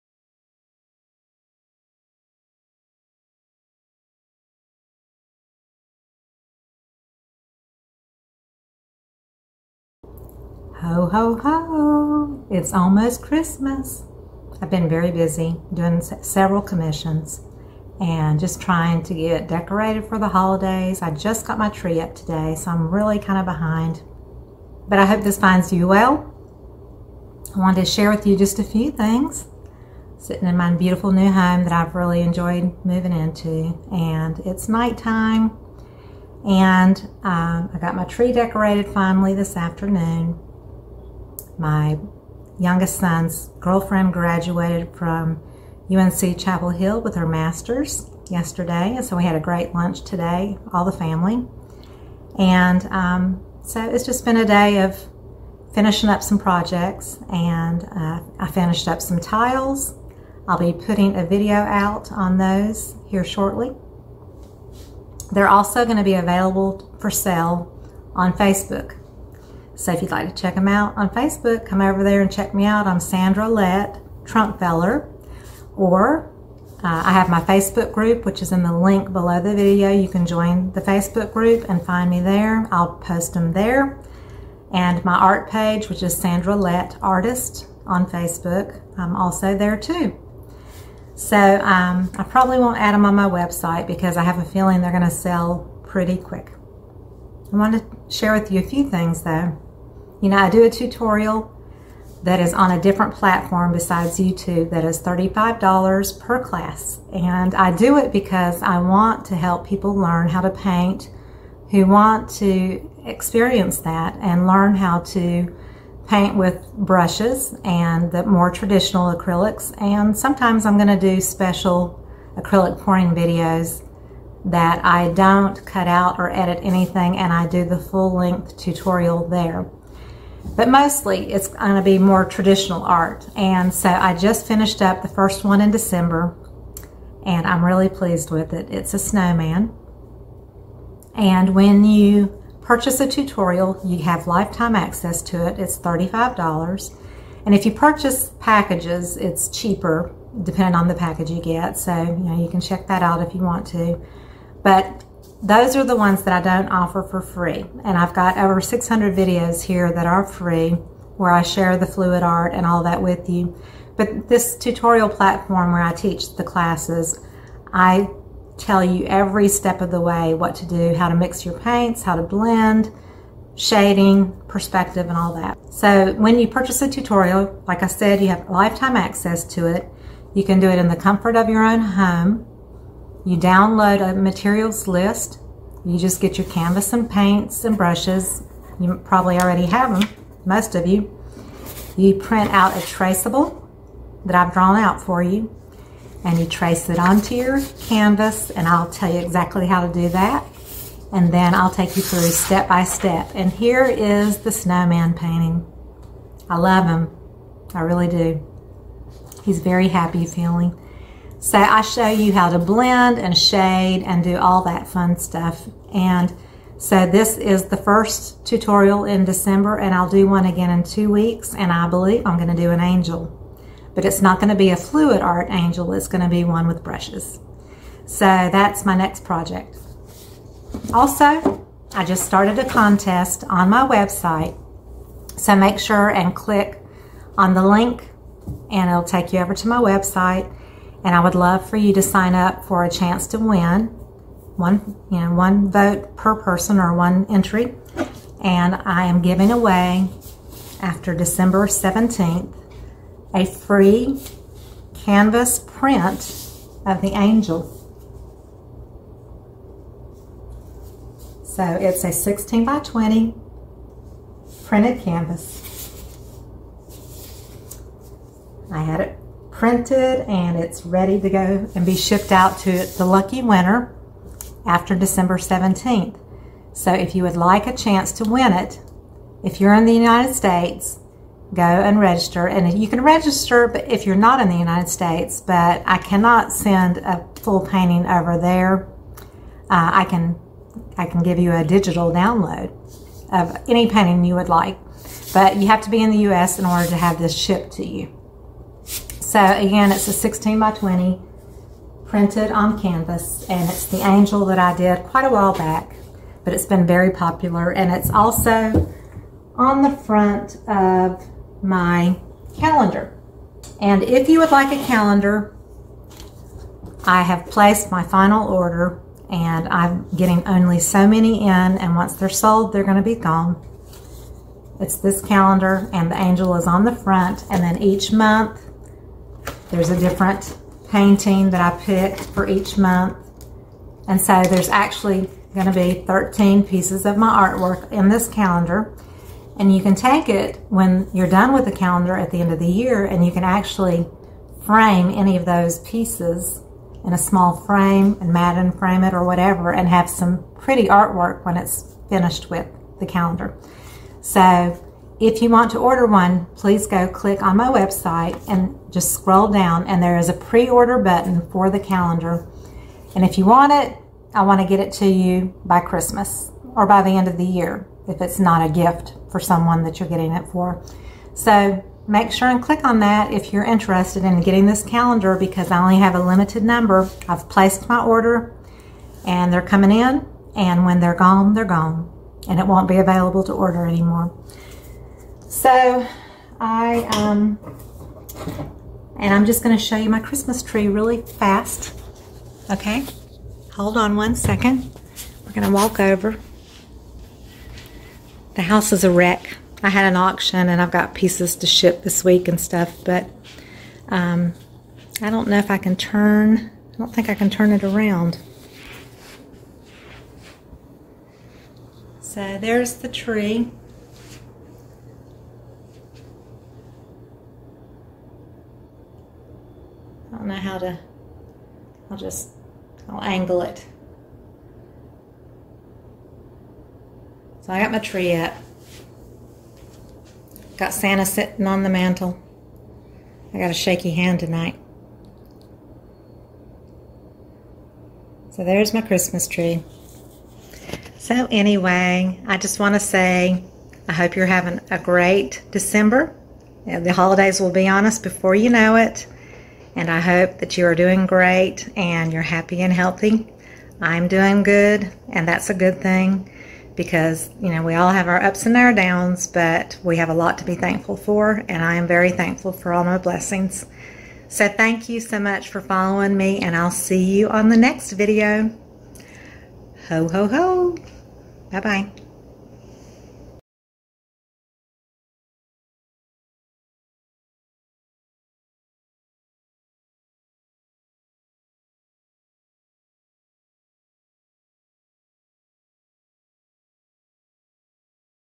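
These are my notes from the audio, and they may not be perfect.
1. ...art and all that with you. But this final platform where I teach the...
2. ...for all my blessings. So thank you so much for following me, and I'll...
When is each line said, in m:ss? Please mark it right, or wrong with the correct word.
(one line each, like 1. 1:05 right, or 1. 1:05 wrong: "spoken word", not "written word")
1. 2:42 wrong: "tutorial", not "final"
2. 7:42 right.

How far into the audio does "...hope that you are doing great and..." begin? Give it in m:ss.
7:30.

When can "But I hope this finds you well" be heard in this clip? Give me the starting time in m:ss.
0:24.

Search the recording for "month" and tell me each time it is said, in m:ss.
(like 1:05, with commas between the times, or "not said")
5:28, 5:32.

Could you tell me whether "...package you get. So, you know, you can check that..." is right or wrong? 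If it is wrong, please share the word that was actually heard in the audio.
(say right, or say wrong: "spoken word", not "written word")
right.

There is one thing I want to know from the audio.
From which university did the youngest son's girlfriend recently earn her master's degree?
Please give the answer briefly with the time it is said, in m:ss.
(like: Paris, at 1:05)
UNC Chapel Hill, at 0:45.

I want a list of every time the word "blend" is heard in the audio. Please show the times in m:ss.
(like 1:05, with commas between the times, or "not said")
2:52, 3:32.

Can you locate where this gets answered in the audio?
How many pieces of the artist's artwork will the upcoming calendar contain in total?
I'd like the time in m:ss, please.
5:36.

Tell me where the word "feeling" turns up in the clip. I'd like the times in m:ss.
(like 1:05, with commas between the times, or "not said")
1:34, 3:30.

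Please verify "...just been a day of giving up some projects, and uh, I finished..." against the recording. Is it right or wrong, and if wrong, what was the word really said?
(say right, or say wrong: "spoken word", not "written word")
wrong: "finishing", not "giving".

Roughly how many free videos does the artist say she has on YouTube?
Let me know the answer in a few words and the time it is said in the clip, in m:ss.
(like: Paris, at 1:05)
over 600, at 2:38.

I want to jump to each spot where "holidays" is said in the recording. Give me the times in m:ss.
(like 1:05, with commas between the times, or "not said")
0:20, 7:27.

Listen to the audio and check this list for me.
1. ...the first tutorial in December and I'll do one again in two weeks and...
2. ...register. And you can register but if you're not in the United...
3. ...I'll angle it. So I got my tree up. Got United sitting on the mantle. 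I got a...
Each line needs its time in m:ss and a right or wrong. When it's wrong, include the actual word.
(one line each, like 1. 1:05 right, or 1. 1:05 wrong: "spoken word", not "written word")
1. 3:37 right
2. 4:41 right
3. 7:03 wrong: "Santa", not "United".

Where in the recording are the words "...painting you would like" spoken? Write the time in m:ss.
4:53.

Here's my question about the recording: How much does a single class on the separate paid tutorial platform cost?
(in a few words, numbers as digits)
$35.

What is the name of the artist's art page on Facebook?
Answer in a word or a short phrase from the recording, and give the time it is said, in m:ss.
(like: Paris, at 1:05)
Sandra Lett Artist, at 1:26.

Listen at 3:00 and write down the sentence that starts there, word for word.
You can do it in the comfort of your own home you download a materials list.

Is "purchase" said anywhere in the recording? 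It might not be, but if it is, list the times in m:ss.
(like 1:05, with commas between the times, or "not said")
2:22, 2:27, 2:56.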